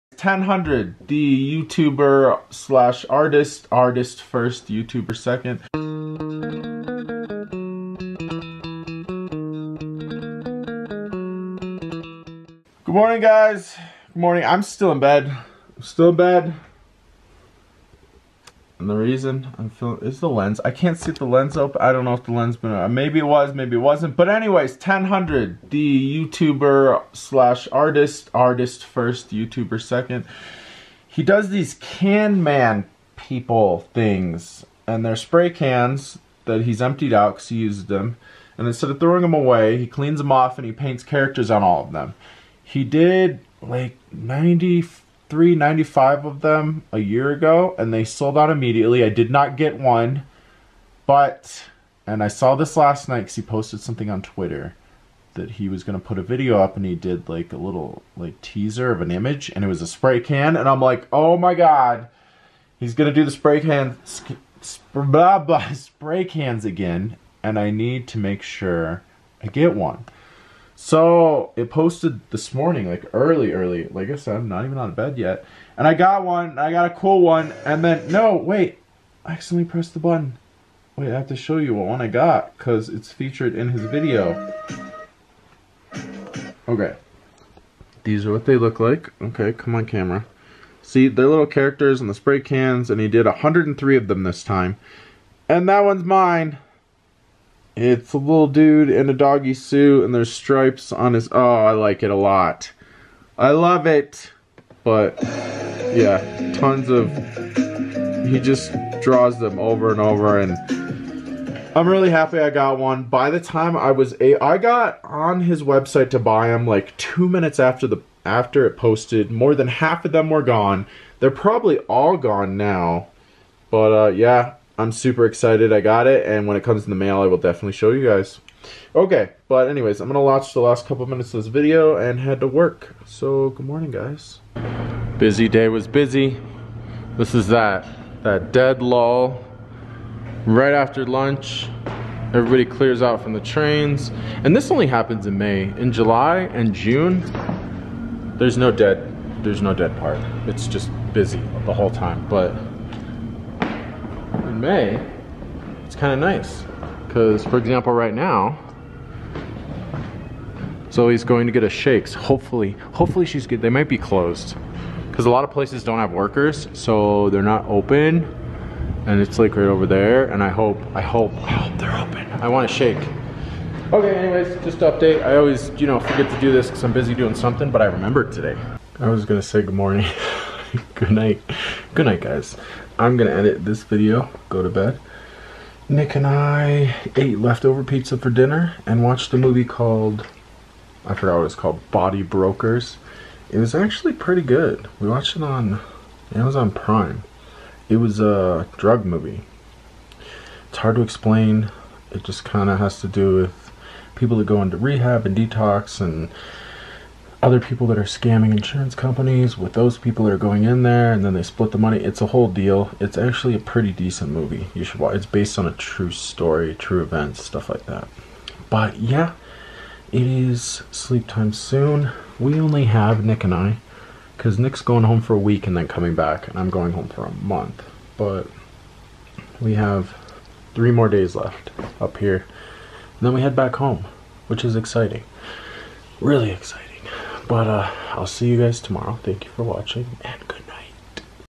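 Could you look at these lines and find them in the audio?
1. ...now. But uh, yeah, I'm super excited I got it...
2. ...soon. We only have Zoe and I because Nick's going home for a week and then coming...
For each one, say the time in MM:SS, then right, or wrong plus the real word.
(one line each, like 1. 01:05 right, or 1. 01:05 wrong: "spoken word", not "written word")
1. 02:02 right
2. 03:41 wrong: "Nick", not "Zoe".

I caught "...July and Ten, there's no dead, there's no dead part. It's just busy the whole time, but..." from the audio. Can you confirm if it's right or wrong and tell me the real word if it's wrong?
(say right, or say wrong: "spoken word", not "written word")
wrong: "June", not "Ten".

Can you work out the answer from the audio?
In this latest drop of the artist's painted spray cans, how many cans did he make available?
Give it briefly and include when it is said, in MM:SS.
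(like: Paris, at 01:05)
103, at 01:33.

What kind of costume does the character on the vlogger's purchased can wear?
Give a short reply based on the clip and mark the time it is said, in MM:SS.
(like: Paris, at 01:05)
doggy suit, at 01:39.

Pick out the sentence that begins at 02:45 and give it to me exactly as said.
Because a lot of places don't have workers, so they're not open.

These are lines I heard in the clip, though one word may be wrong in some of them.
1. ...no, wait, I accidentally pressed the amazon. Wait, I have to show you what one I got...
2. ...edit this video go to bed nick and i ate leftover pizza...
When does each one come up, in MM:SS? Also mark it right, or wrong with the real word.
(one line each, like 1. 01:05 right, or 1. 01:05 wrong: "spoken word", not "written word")
1. 01:18 wrong: "button", not "amazon"
2. 03:03 right.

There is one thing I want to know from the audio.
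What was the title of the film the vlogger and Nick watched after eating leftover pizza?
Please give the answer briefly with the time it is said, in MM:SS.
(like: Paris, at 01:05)
Body Brokers, at 03:11.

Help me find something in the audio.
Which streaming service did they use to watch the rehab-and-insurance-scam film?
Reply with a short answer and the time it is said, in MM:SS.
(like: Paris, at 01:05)
Amazon Prime, at 03:16.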